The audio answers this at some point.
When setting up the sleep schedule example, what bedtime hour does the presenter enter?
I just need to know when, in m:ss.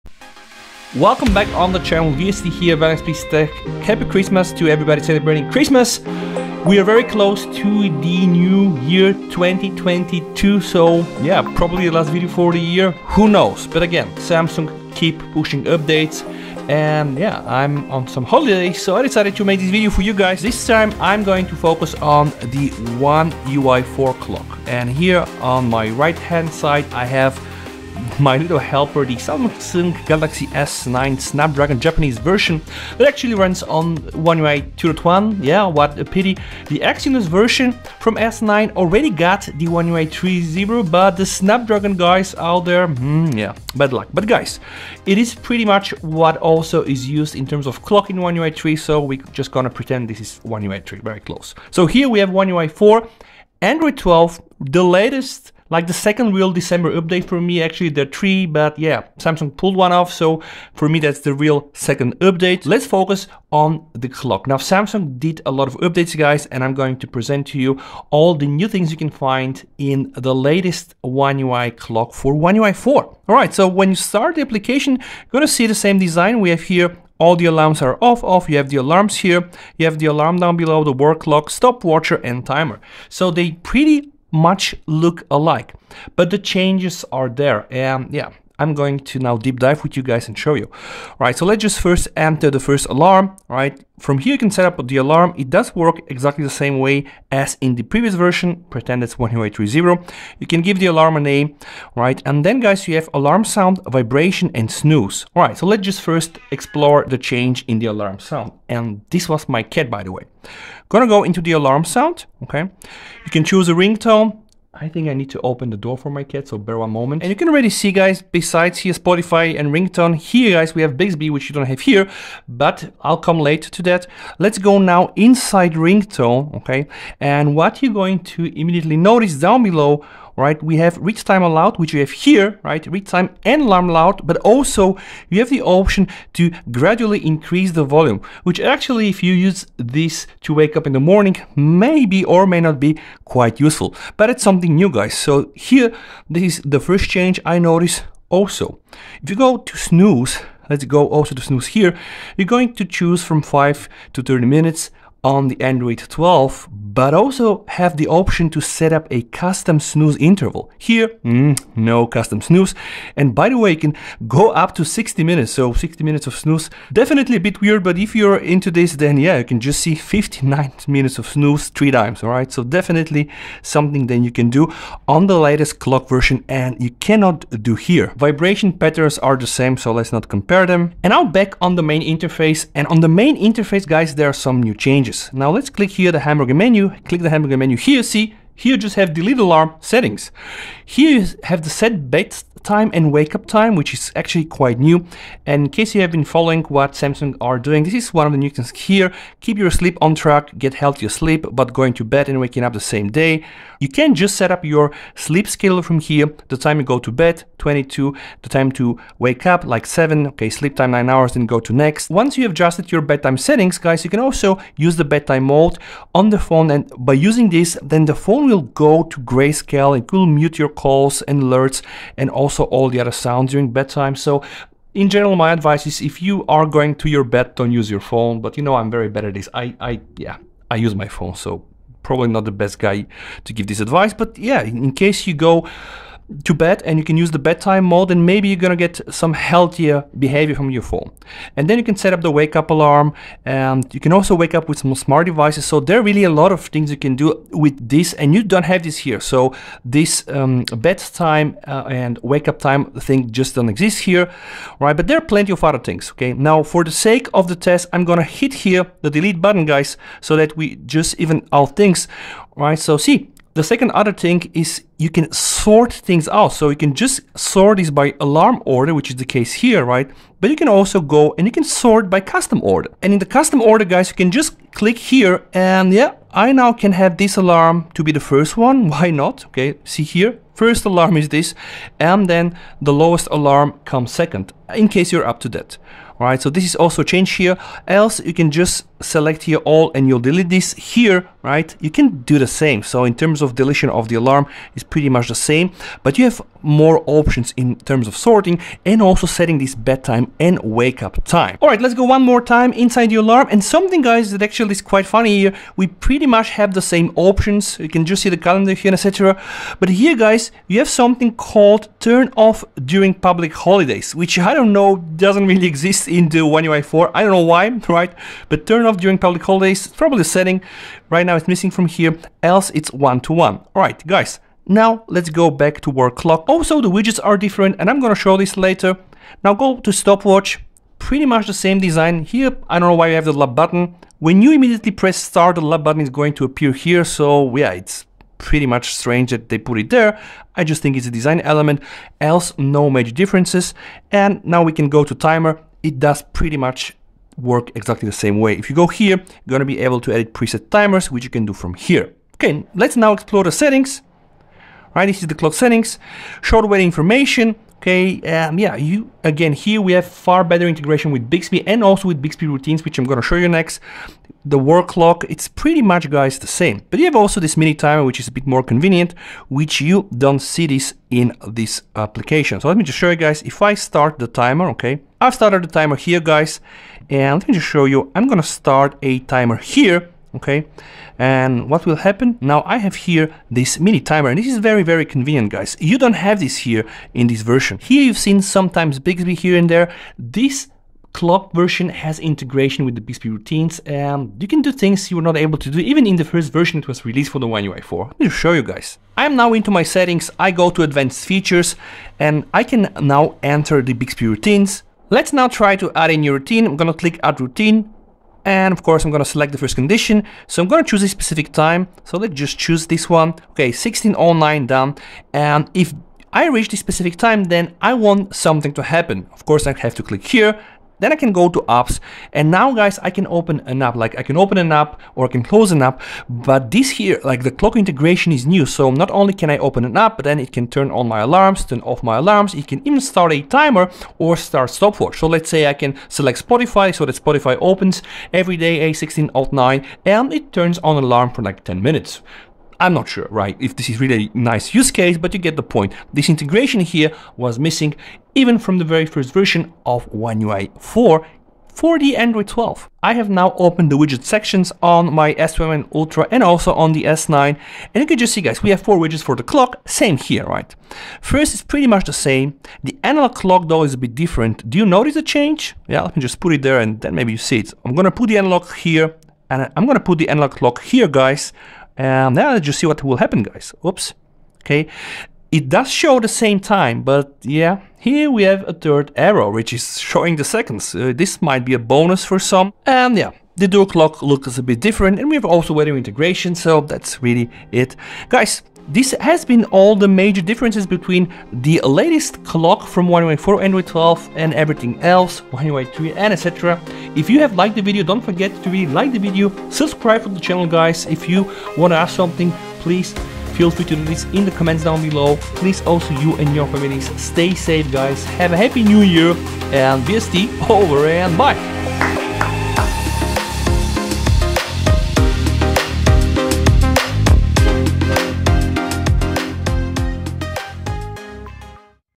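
3:27.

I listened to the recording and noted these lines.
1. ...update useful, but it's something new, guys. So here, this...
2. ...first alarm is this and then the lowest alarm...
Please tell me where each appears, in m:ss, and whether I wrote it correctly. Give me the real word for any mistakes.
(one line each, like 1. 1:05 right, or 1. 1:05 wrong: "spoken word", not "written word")
1. 2:23 wrong: "quite", not "update"
2. 4:40 right.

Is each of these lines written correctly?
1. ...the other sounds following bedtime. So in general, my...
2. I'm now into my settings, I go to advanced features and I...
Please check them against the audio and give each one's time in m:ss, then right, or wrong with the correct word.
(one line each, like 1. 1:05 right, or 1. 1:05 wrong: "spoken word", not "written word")
1. 3:42 wrong: "during", not "following"
2. 6:39 right.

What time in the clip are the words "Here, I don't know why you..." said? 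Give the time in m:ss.
5:32.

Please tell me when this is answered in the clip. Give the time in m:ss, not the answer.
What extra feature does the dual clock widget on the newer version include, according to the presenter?
8:05.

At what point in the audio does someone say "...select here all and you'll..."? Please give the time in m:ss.
4:49.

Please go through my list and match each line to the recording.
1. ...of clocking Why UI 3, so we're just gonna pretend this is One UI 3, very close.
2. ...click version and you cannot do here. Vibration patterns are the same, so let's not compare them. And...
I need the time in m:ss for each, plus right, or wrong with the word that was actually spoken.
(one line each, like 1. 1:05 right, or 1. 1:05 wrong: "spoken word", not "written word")
1. 0:47 wrong: "One", not "Why"
2. 2:55 wrong: "clock", not "click".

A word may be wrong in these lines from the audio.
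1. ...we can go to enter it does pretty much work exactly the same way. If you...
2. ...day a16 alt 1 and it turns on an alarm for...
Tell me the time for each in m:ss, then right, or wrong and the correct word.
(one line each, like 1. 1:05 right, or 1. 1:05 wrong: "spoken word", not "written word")
1. 5:44 wrong: "timer", not "enter"
2. 7:18 wrong: "9", not "1".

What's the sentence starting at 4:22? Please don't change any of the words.
So see, the second other thing is you can sort things out.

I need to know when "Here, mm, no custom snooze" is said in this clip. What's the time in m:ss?
2:40.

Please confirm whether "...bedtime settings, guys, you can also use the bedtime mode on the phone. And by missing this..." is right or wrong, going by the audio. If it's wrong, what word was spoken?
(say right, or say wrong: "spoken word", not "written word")
wrong: "using", not "missing".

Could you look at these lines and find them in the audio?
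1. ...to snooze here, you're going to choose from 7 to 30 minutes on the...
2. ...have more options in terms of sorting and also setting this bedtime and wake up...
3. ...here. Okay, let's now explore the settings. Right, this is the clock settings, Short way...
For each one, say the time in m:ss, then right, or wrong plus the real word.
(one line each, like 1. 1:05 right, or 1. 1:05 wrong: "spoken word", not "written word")
1. 2:31 wrong: "5", not "7"
2. 4:56 right
3. 5:51 right.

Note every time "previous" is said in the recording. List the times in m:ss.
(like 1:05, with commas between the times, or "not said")
1:37.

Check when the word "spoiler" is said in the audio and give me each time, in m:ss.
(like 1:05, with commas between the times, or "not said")
not said.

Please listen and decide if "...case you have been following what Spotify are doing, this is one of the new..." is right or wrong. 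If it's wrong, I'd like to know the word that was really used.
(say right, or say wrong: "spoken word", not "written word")
wrong: "Samsung", not "Spotify".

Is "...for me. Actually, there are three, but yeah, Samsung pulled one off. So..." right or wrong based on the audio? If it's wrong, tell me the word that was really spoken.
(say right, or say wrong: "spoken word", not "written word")
right.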